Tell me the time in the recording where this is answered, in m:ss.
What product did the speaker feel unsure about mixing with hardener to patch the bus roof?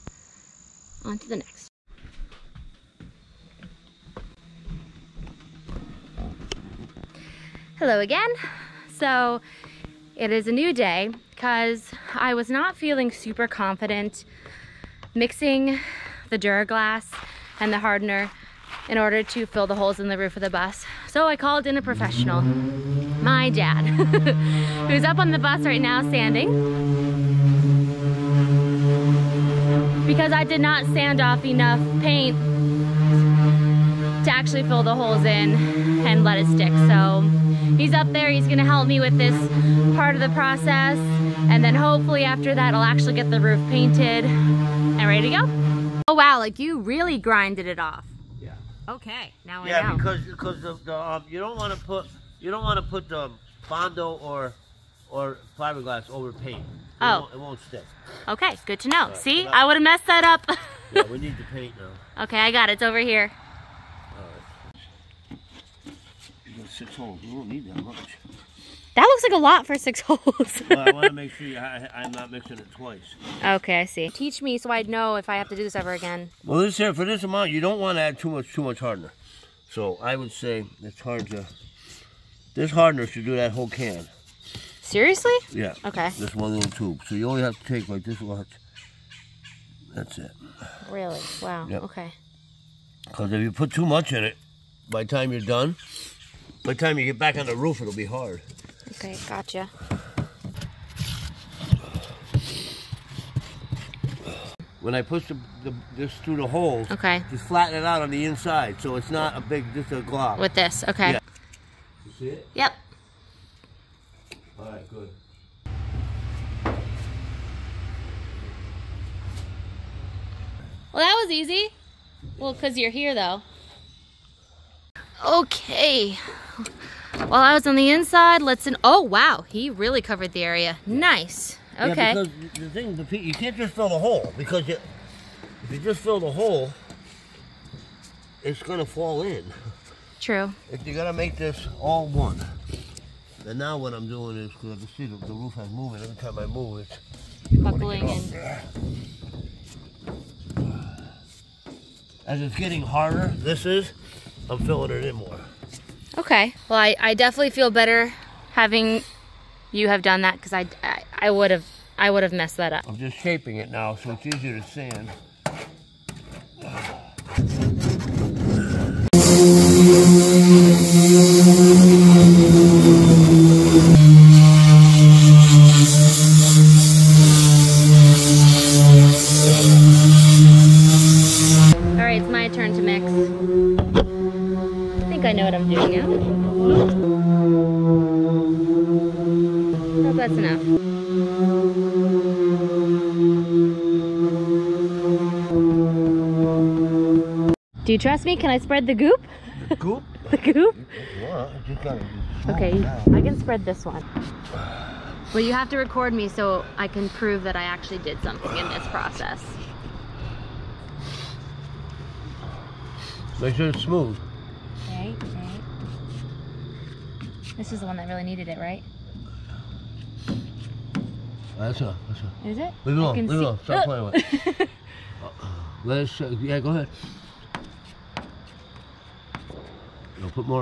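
0:16.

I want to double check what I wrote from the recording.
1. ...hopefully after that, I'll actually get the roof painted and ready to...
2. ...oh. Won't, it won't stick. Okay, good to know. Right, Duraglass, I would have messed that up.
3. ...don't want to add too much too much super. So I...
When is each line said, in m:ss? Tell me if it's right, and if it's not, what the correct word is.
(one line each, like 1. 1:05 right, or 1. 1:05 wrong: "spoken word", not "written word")
1. 0:41 right
2. 0:57 wrong: "See", not "Duraglass"
3. 1:17 wrong: "hardener", not "super".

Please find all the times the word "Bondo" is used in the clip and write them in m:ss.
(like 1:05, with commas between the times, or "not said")
0:53.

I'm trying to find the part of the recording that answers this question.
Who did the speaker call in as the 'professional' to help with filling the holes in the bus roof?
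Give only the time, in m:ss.
0:22.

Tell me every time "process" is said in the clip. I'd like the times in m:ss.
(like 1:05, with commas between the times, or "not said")
0:40, 3:28.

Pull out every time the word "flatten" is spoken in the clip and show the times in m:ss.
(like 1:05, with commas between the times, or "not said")
1:47.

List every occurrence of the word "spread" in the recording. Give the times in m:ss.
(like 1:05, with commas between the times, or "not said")
3:18, 3:23.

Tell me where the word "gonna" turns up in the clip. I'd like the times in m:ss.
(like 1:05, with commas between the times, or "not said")
0:38.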